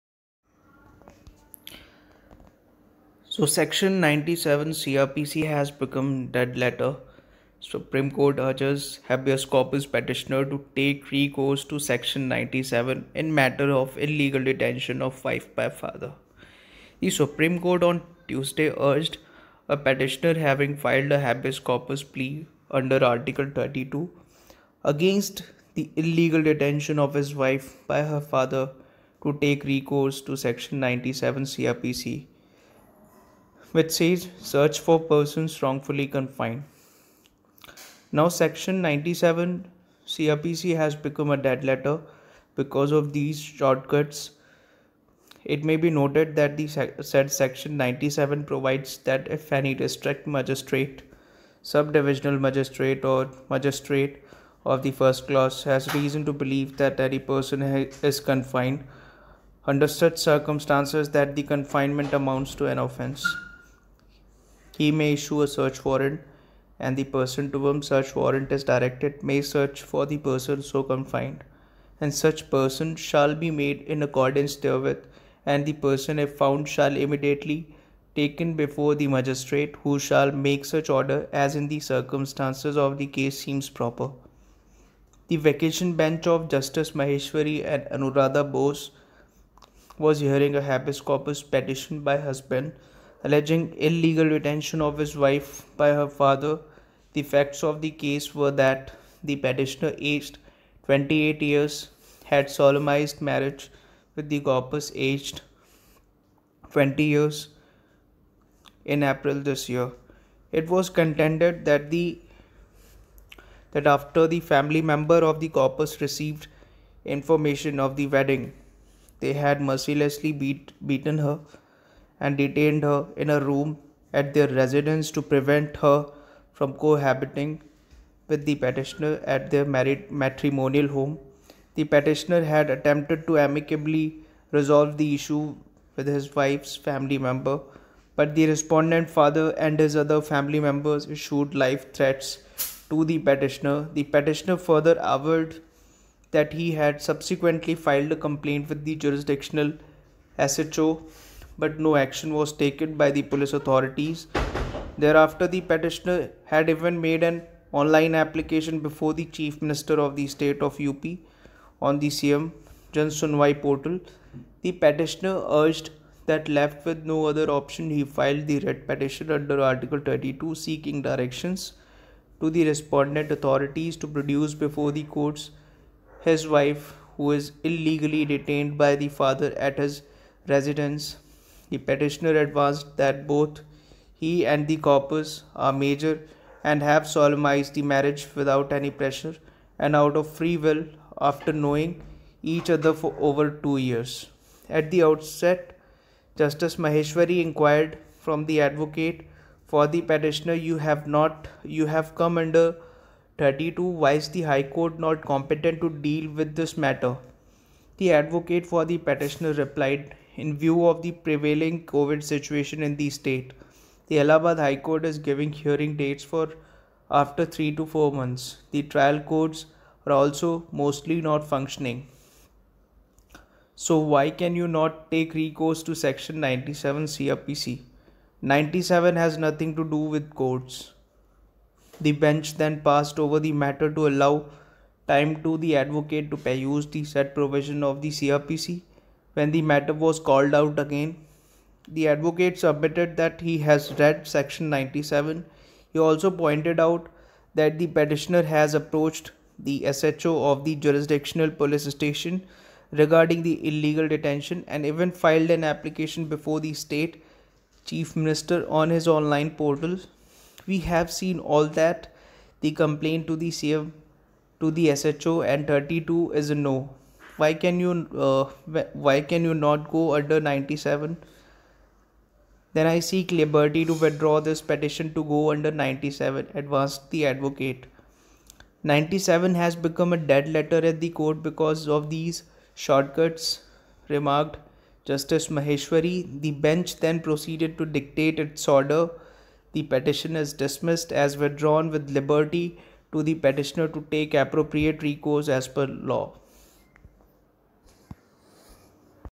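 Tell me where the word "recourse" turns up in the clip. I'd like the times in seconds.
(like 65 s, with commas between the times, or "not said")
11 s, 29 s, 225 s, 295 s.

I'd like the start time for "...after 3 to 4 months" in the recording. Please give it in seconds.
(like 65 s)
217 s.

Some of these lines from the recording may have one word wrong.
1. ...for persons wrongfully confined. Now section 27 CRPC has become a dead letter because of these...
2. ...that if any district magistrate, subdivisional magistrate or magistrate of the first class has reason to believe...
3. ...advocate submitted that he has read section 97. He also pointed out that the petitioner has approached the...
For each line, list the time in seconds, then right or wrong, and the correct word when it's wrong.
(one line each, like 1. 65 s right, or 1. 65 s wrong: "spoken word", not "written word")
1. 34 s wrong: "97", not "27"
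2. 48 s right
3. 242 s right.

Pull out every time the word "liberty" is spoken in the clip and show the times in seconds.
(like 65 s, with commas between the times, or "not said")
273 s, 292 s.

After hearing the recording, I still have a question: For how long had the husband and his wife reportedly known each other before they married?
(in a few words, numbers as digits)
over two years.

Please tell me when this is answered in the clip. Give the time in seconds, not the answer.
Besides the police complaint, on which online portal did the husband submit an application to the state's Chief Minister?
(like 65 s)
162 s.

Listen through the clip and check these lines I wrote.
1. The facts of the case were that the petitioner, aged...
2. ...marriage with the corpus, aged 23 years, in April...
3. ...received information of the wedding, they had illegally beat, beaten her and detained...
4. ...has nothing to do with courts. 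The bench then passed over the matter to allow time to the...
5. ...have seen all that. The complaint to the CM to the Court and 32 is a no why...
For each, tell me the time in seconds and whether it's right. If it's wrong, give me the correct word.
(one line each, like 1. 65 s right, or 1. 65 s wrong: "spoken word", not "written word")
1. 97 s right
2. 103 s wrong: "20", not "23"
3. 116 s wrong: "mercilessly", not "illegally"
4. 229 s right
5. 260 s wrong: "SHO", not "Court".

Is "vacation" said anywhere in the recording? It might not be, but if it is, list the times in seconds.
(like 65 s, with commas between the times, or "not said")
85 s.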